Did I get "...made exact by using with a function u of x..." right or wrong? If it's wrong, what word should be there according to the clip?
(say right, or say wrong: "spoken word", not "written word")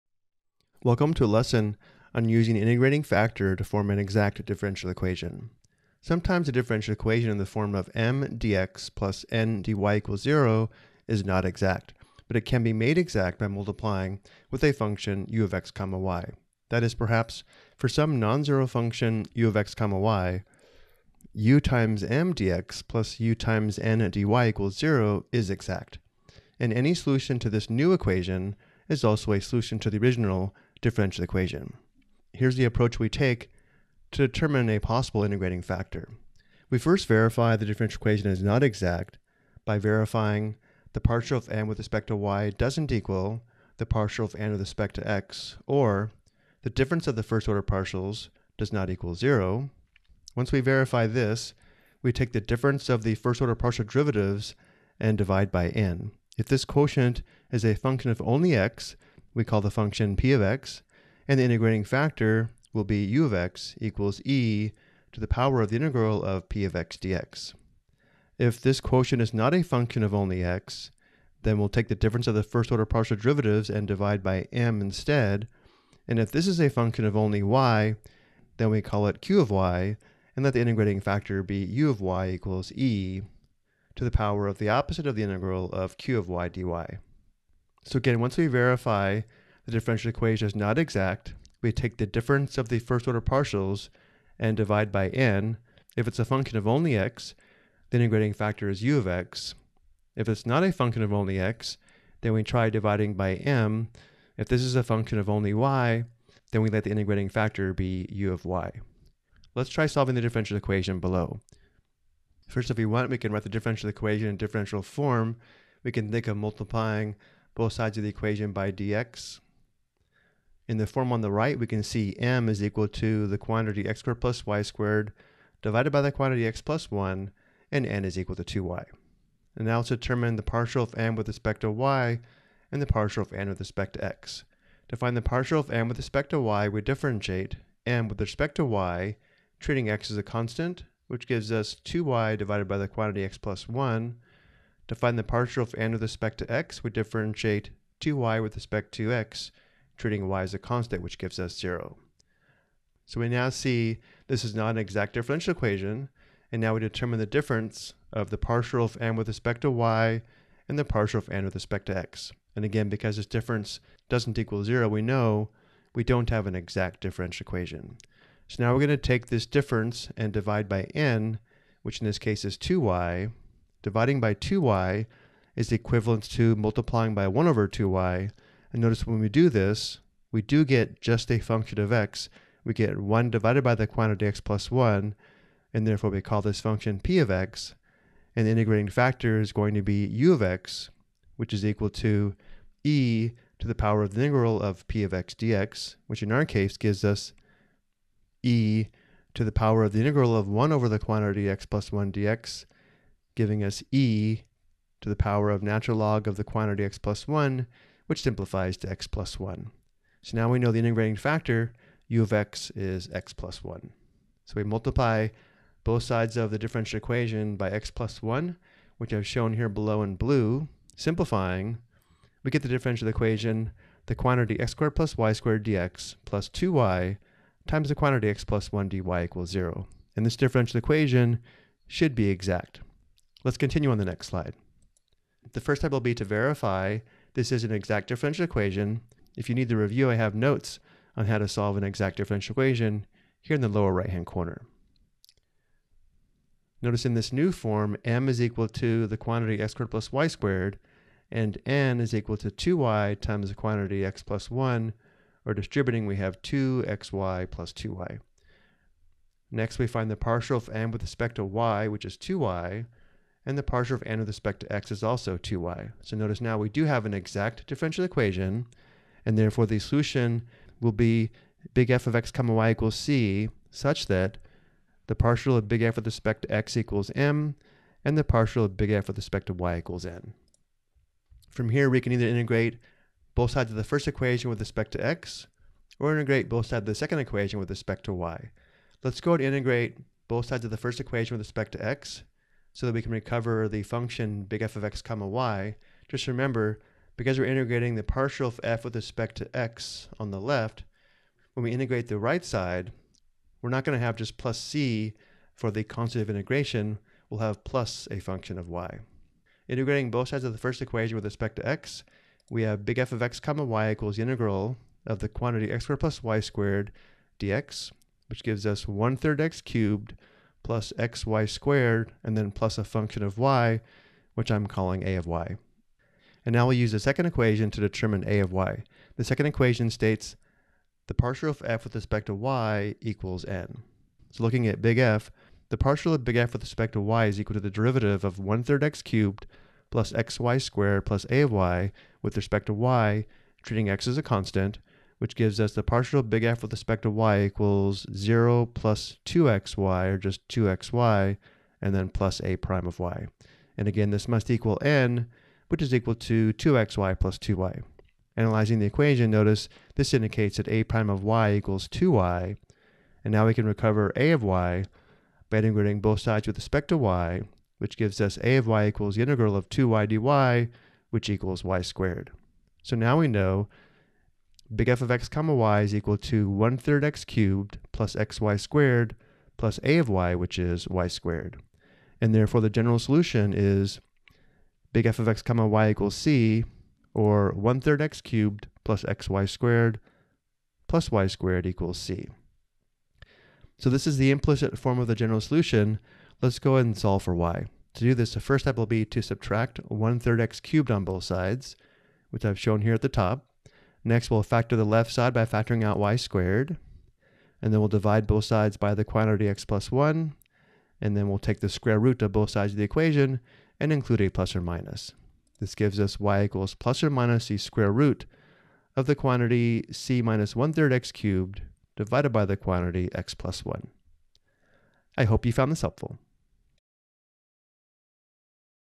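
wrong: "multiplying", not "using".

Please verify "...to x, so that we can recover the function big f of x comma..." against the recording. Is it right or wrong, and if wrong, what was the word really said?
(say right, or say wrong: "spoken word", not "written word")
right.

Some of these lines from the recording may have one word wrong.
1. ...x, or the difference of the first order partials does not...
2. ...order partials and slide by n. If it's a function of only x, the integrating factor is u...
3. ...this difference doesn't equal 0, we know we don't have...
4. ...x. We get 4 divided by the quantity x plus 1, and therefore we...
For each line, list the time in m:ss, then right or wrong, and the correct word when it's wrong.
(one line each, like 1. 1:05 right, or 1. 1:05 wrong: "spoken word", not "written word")
1. 0:45 right
2. 1:33 wrong: "divide", not "slide"
3. 2:43 right
4. 3:01 wrong: "1", not "4".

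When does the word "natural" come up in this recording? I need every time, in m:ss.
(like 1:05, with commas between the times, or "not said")
3:25.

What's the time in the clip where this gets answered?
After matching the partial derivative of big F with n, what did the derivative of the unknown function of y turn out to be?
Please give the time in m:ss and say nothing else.
6:00.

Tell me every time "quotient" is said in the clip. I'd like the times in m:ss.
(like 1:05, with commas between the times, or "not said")
0:56, 1:08.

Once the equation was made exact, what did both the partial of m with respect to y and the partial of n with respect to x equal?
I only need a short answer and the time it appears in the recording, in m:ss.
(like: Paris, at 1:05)
2y, at 4:25.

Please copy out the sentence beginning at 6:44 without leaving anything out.
Next, we'll factor the left side by factoring out y squared.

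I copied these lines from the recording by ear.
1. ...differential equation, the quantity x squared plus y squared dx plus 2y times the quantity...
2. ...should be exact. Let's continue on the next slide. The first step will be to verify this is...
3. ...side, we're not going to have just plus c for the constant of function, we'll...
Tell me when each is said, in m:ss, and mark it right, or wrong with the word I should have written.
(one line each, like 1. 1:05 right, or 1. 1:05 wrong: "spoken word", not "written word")
1. 3:42 right
2. 3:51 right
3. 5:02 wrong: "integration", not "function".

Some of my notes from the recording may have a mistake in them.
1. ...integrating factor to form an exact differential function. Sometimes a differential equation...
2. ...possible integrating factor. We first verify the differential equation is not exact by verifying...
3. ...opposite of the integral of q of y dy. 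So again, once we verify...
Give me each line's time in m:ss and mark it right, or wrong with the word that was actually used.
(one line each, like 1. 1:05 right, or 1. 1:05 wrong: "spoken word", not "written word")
1. 0:02 wrong: "equation", not "function"
2. 0:34 right
3. 1:24 right.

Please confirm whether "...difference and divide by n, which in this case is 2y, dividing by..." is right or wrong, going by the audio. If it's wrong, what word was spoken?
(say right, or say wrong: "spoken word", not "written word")
right.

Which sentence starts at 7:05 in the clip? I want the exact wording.
I hope you found this helpful.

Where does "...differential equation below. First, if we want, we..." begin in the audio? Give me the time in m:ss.
1:50.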